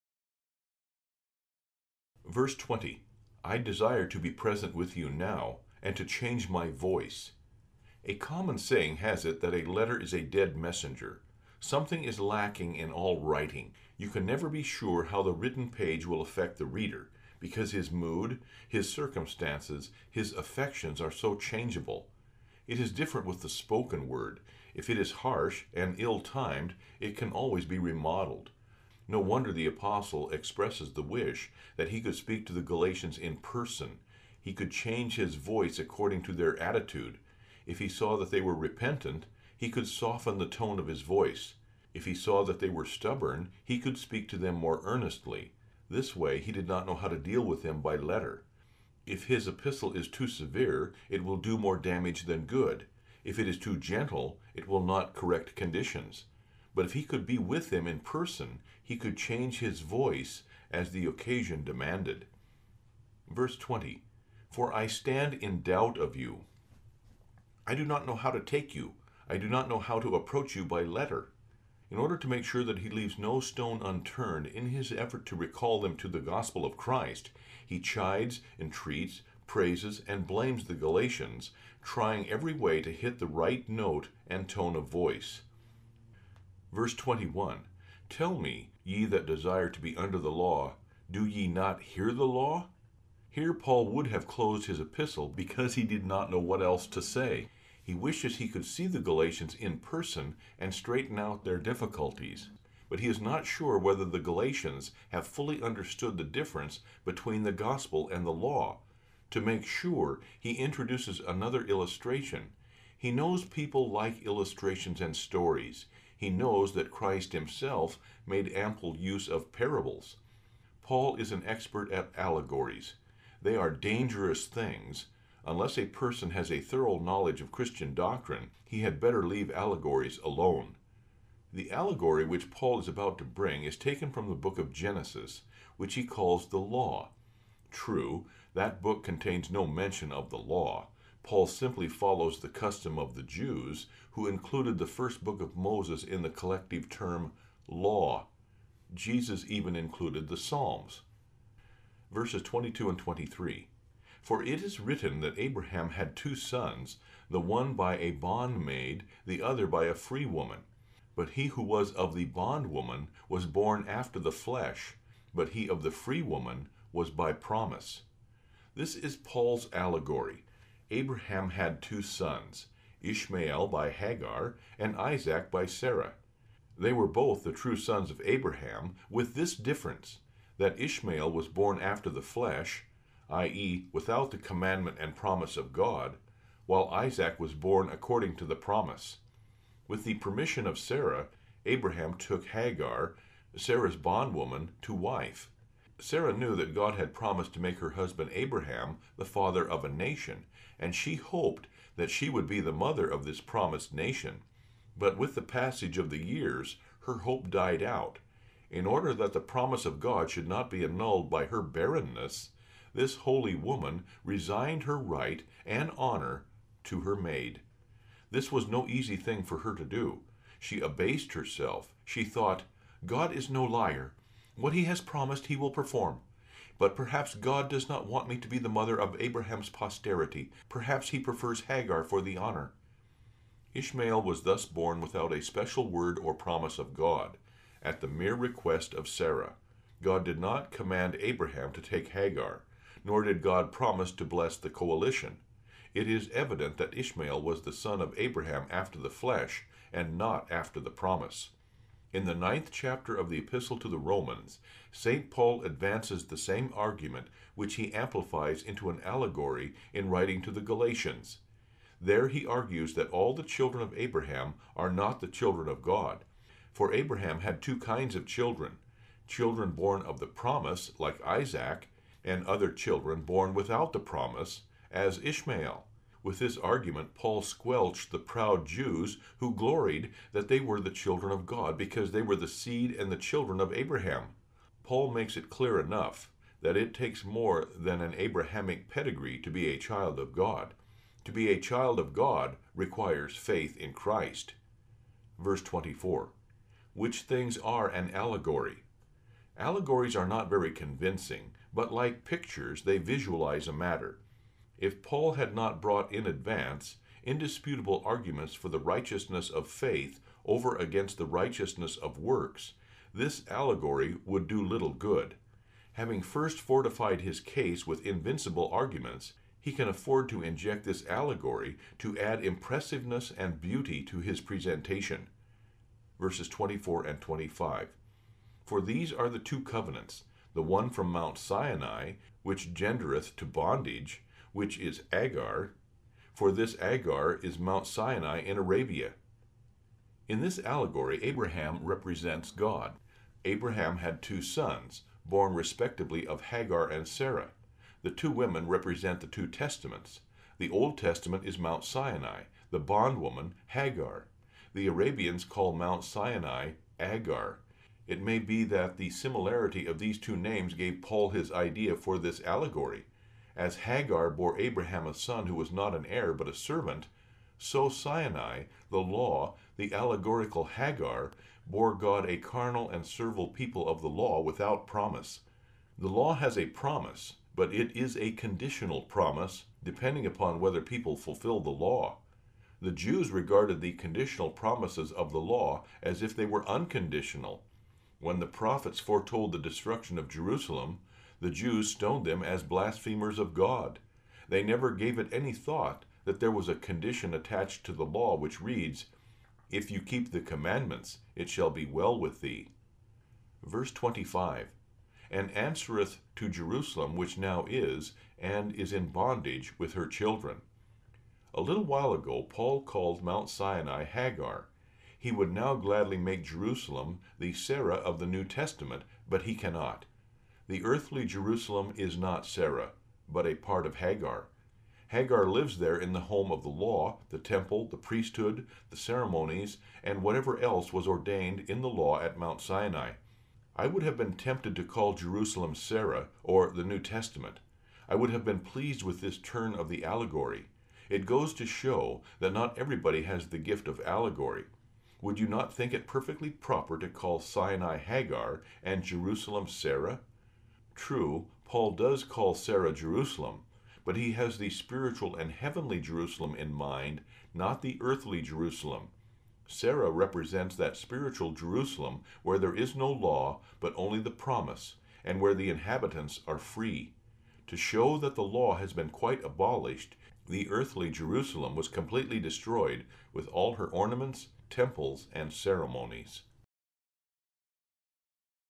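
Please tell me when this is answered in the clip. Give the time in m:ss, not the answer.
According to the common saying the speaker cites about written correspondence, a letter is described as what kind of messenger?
0:10.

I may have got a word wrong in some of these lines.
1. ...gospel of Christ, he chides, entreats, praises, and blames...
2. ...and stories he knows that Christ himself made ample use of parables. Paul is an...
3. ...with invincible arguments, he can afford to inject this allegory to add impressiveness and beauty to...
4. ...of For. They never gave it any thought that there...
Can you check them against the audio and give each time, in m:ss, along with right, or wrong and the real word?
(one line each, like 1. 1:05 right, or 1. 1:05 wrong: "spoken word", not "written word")
1. 1:16 right
2. 1:55 right
3. 5:17 right
4. 6:33 wrong: "God", not "For".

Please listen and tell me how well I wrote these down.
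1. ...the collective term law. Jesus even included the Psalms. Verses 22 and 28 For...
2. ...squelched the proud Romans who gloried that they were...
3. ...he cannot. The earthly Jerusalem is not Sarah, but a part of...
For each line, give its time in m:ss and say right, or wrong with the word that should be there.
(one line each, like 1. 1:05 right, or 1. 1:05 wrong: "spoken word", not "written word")
1. 2:26 wrong: "23", not "28"
2. 4:37 wrong: "Jews", not "Romans"
3. 6:59 right.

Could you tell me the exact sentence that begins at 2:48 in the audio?
This is Paul's allegory Abraham had two sons, Ishmael by Hagar, and Isaac by Sarah.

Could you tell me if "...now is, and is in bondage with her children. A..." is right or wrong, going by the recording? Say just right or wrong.
right.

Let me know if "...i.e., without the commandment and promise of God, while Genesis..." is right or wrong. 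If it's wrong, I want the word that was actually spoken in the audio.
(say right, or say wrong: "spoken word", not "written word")
wrong: "Isaac", not "Genesis".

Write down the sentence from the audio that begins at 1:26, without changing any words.
Verse 21 Tell me, ye that desire to be under the law, do ye not hear the law?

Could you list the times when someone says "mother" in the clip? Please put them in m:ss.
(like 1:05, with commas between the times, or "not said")
3:22, 3:48.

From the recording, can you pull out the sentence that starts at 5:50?
The Old Testament is Mount Sinai, the bondwoman, Hagar.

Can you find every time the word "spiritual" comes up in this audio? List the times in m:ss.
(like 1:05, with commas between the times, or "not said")
7:34, 7:40.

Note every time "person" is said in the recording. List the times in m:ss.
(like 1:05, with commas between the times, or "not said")
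0:33, 0:57, 1:39, 2:05.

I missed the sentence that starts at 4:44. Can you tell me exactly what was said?
Paul makes it clear enough that it takes more than an Abrahamic pedigree to be a child of God.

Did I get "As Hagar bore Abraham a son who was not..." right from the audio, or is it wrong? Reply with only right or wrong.
right.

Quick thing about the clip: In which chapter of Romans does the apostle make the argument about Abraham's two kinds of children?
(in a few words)
9th chapter.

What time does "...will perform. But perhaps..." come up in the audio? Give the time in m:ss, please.
3:45.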